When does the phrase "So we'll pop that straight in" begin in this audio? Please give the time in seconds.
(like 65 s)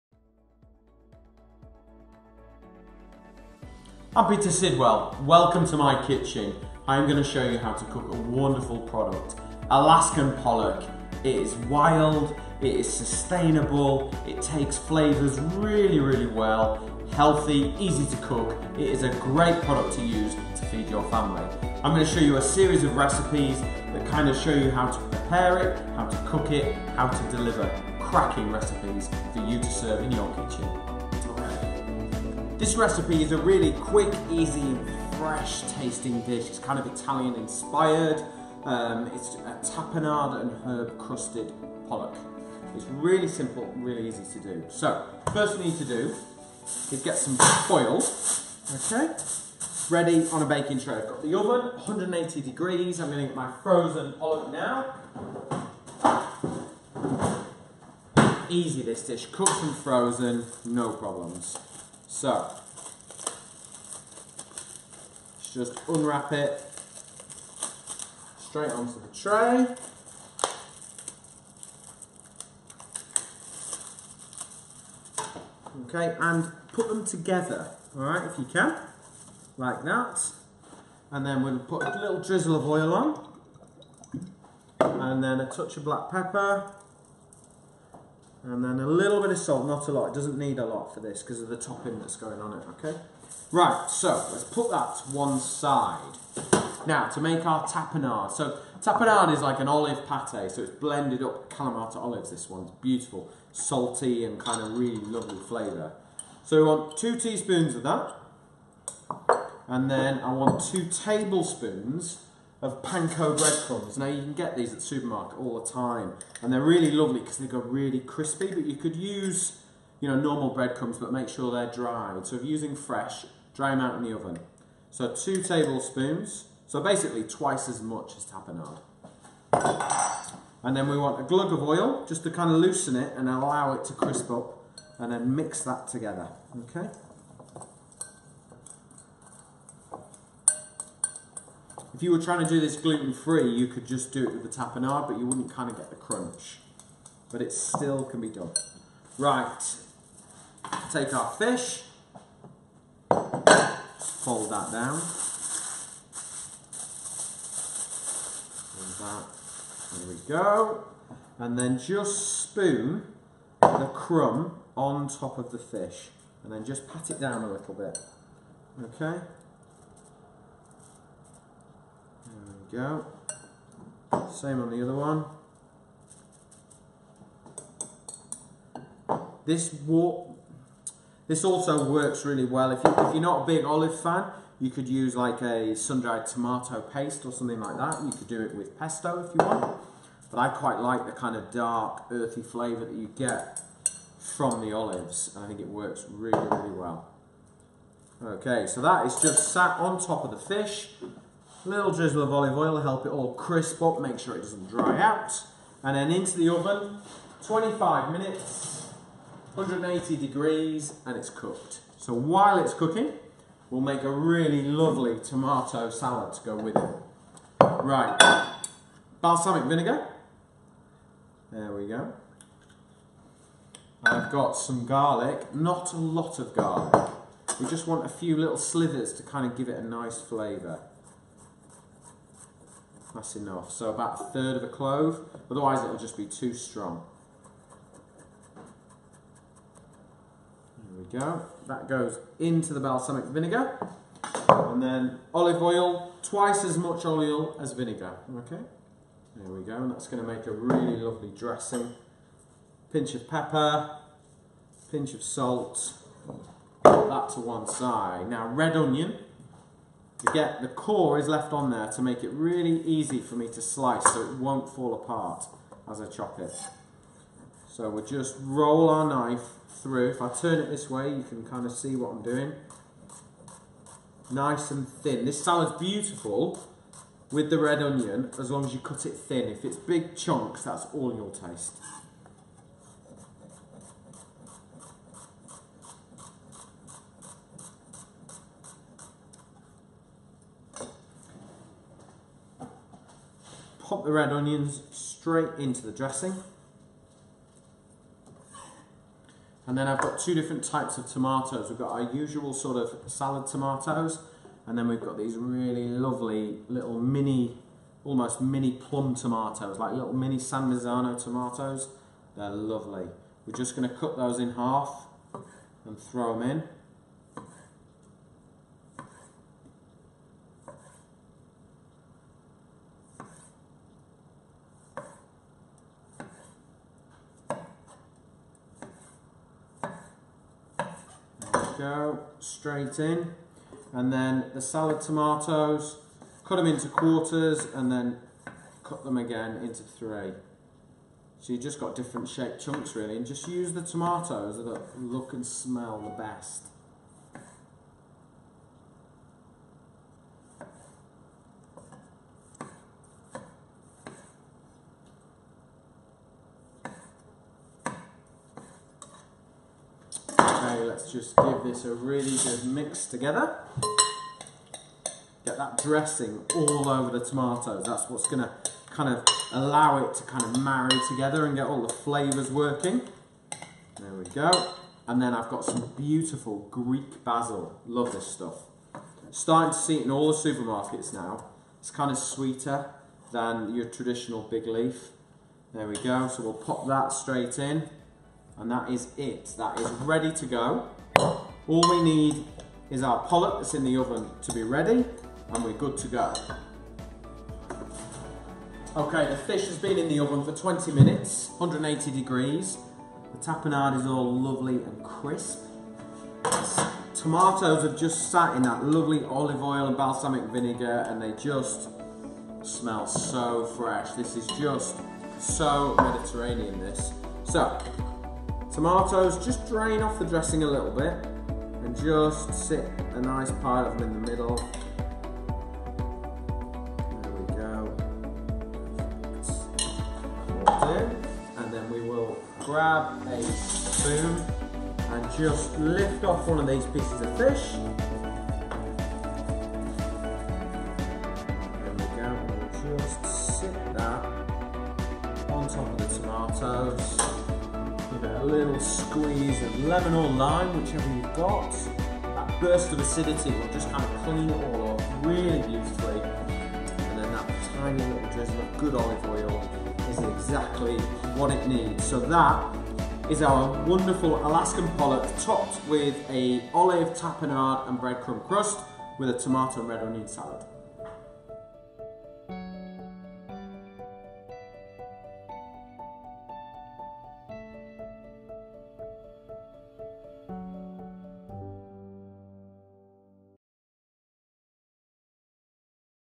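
386 s.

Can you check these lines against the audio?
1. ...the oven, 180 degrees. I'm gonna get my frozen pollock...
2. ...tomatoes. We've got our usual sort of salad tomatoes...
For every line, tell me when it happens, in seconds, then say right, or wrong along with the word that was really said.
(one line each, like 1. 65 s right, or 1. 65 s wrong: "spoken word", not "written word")
1. 51 s right
2. 301 s right.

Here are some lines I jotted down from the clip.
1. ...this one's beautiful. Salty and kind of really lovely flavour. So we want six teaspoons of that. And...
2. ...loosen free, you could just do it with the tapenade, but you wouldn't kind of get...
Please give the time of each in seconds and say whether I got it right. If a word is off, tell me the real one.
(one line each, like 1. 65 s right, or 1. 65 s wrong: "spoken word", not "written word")
1. 102 s wrong: "two", not "six"
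2. 142 s wrong: "gluten", not "loosen".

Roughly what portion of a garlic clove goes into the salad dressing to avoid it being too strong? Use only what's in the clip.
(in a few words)
a third.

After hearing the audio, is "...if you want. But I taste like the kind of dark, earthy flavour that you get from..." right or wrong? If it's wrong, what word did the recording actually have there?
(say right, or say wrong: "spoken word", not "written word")
wrong: "quite", not "taste".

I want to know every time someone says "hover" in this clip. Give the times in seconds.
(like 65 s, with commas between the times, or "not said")
not said.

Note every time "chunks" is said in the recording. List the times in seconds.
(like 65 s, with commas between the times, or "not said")
280 s, 342 s.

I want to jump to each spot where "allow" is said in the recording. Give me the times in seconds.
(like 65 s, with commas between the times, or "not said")
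133 s, 369 s.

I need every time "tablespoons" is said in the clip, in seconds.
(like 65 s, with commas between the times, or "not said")
110 s, 125 s.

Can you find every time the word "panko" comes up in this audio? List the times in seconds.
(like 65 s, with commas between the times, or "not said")
112 s.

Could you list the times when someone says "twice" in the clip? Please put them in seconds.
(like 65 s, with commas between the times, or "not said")
127 s, 246 s.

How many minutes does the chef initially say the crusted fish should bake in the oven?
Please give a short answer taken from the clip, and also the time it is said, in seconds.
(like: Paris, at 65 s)
25, at 207 s.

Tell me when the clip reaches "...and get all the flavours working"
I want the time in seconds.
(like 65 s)
371 s.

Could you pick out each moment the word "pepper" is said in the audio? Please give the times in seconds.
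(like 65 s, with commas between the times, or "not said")
86 s, 253 s.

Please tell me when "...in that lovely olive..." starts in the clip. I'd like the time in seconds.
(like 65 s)
408 s.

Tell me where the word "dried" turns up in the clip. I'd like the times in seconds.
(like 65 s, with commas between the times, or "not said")
121 s, 185 s.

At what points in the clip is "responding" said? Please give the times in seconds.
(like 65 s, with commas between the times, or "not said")
not said.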